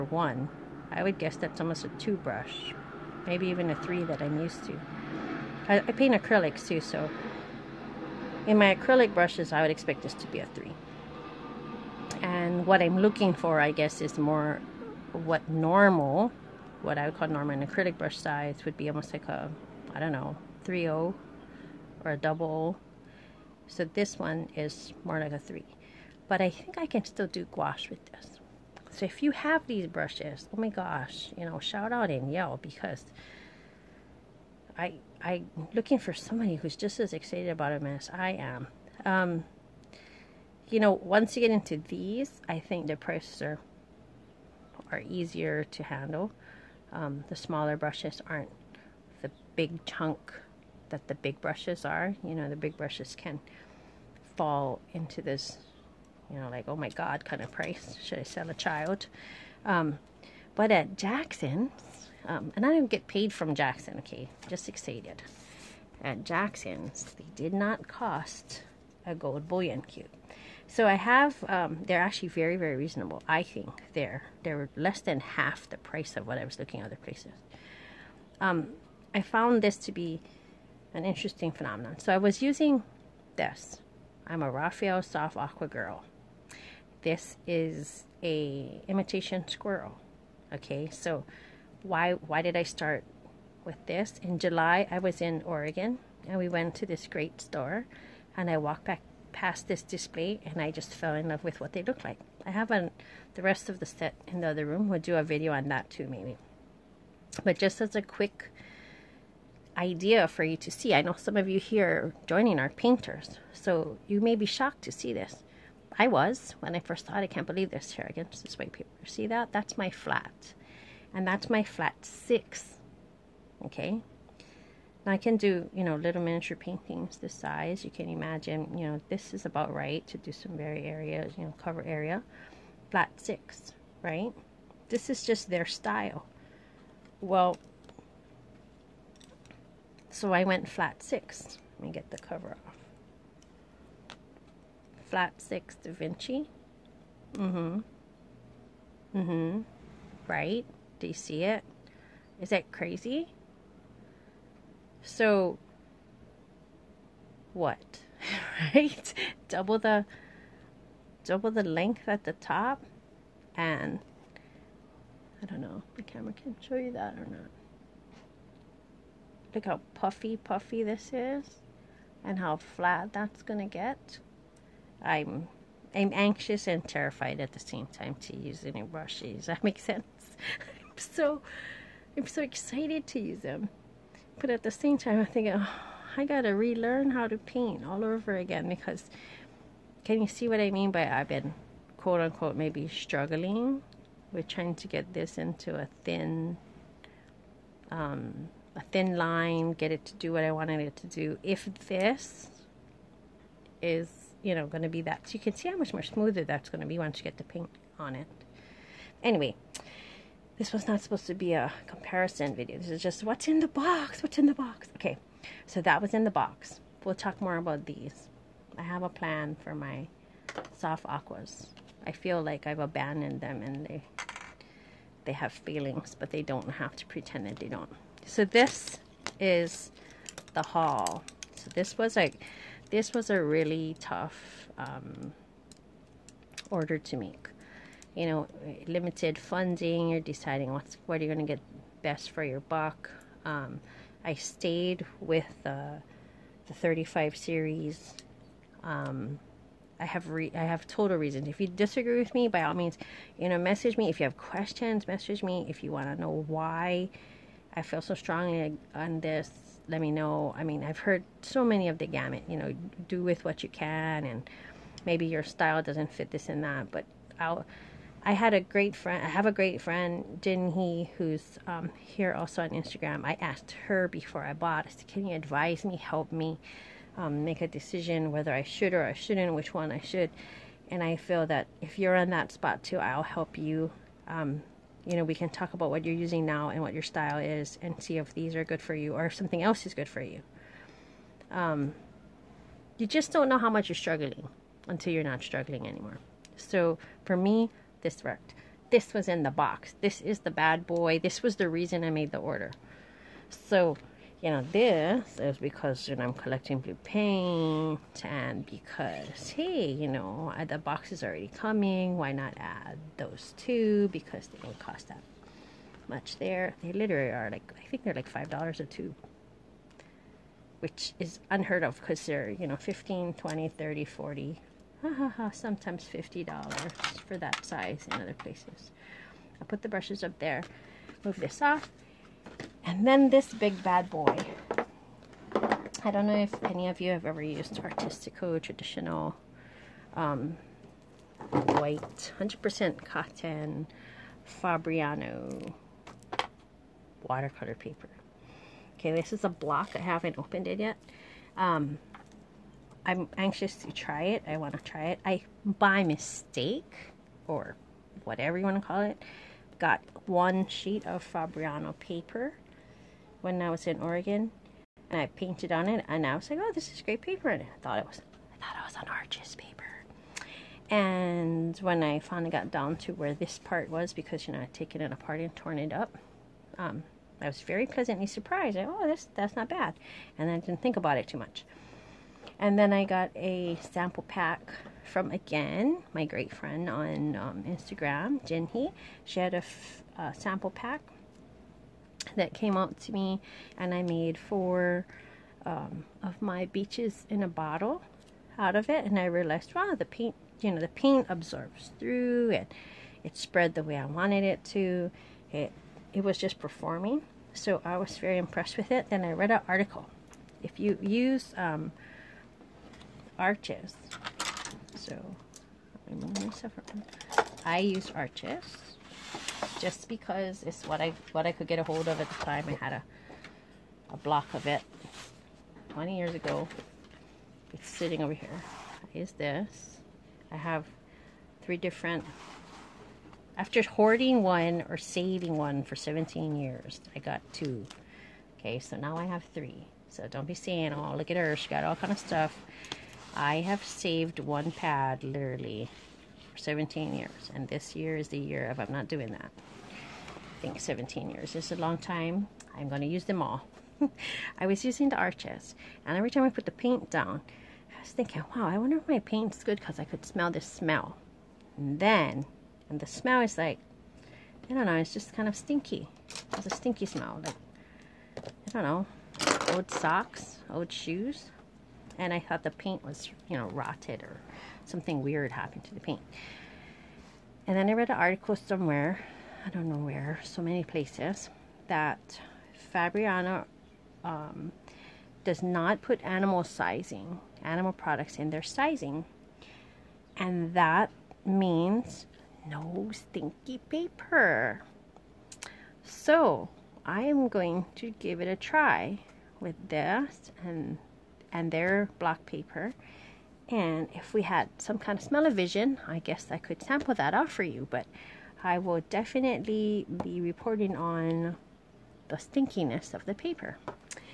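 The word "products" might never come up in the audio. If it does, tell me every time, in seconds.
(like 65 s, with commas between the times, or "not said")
487 s.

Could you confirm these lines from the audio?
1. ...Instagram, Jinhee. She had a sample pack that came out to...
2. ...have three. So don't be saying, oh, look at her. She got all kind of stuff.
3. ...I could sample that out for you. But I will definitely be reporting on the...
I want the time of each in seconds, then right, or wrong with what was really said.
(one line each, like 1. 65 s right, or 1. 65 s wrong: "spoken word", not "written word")
1. 387 s right
2. 439 s right
3. 506 s right.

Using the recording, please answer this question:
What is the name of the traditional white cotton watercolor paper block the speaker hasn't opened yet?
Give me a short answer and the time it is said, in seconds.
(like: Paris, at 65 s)
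Artistico, at 337 s.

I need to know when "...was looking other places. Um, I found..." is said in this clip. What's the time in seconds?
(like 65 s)
76 s.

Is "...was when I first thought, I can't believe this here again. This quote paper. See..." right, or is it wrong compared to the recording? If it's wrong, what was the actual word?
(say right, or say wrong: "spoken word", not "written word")
wrong: "white", not "quote".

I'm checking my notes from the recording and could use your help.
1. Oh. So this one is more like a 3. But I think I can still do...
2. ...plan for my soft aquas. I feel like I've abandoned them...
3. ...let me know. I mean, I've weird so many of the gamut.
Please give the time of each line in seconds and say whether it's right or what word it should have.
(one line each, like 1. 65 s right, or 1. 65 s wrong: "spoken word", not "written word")
1. 22 s right
2. 219 s right
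3. 259 s wrong: "heard", not "weird".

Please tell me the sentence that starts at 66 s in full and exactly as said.
At Jackson's, they did not cost a gold bullion cube.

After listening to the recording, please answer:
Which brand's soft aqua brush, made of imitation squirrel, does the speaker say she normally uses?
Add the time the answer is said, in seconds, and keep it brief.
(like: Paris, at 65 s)
Raphael, at 84 s.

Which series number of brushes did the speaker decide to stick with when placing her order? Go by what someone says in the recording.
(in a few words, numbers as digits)
35.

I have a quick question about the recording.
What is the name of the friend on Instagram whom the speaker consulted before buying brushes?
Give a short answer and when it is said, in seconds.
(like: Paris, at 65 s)
Jin Hee, at 270 s.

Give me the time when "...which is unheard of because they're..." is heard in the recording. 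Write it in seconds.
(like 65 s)
320 s.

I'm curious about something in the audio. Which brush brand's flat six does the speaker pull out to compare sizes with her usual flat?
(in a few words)
Da Vinci.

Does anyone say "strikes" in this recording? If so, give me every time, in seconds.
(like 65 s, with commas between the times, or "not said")
not said.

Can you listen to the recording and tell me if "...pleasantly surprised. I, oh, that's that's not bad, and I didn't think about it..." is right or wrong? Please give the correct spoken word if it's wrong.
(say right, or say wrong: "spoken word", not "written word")
right.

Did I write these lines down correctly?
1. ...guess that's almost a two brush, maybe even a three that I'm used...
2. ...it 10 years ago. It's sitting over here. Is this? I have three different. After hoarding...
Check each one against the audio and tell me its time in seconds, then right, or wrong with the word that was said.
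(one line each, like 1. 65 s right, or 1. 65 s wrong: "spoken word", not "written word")
1. 1 s right
2. 424 s wrong: "20", not "10".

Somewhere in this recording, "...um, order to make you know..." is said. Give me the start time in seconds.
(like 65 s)
234 s.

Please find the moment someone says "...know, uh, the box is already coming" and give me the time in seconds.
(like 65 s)
310 s.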